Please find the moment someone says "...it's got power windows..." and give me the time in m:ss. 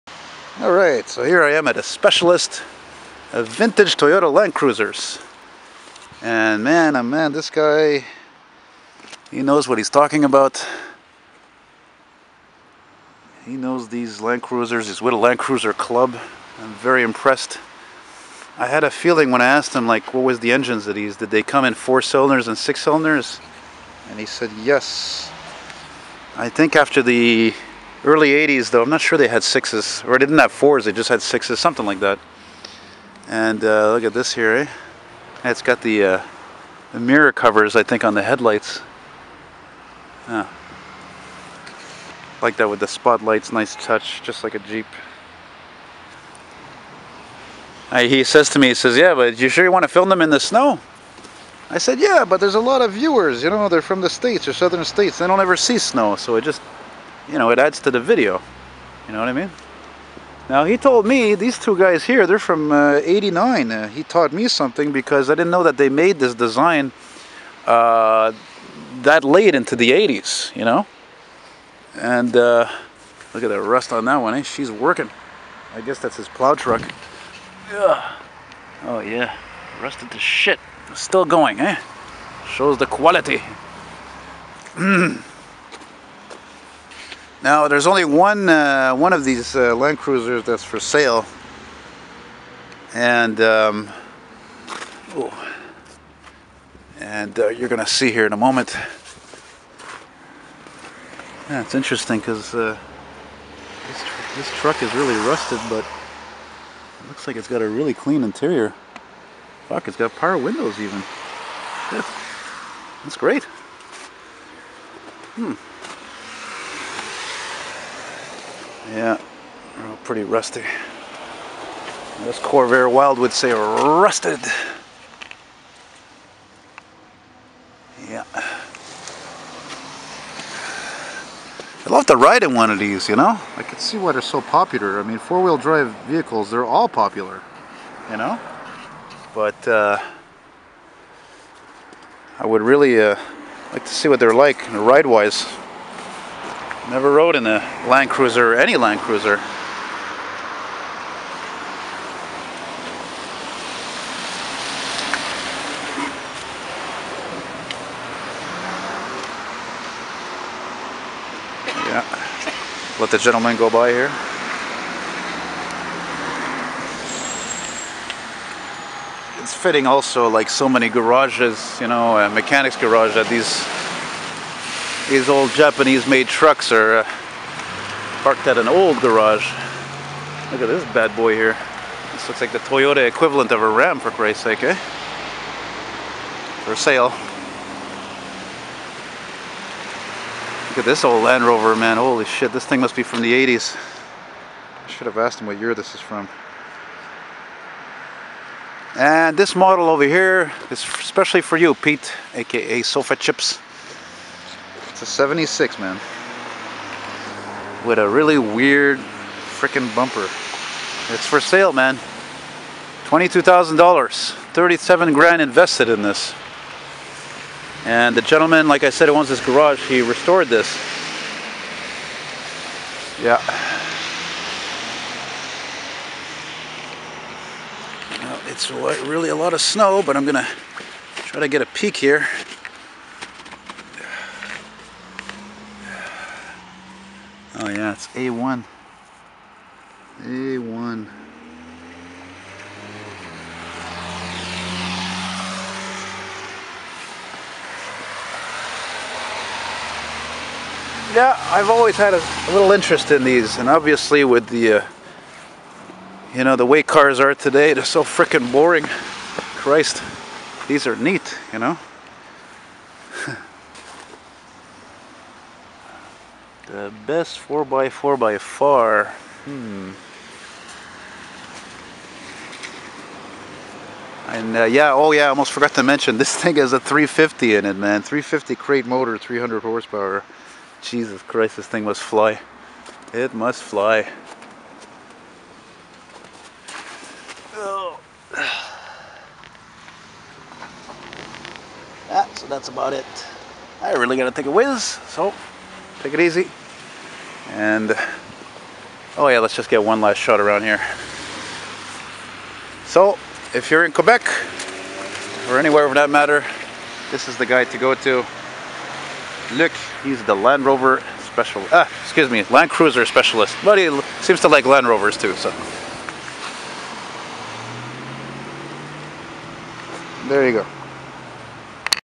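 1:49.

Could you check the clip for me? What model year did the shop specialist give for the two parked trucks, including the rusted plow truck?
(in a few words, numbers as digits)
1989.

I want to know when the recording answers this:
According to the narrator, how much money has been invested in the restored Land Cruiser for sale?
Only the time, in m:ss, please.
3:34.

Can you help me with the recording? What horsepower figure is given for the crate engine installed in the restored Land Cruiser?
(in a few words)
300.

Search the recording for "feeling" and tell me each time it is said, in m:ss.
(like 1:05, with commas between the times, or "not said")
0:18.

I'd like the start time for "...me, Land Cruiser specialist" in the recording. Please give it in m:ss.
5:12.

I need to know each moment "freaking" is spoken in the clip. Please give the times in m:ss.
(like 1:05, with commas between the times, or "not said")
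3:28, 4:18.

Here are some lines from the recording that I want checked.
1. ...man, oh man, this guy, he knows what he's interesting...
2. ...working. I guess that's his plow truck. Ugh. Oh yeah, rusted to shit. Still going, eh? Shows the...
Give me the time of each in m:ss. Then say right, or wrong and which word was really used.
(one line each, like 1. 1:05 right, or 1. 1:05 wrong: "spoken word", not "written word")
1. 0:06 wrong: "talking", not "interesting"
2. 1:14 right.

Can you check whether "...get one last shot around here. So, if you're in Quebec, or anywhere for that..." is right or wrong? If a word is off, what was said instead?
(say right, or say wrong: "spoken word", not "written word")
right.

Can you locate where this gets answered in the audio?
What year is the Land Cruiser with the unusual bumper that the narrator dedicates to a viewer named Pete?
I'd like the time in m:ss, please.
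3:25.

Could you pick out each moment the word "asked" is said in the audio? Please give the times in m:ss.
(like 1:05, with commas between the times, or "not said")
0:19, 3:15.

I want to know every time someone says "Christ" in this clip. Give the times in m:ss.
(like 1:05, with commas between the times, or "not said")
3:04, 4:18, 4:41.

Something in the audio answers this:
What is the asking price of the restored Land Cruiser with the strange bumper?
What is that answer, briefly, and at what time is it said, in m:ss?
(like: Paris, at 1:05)
$22,000, at 3:33.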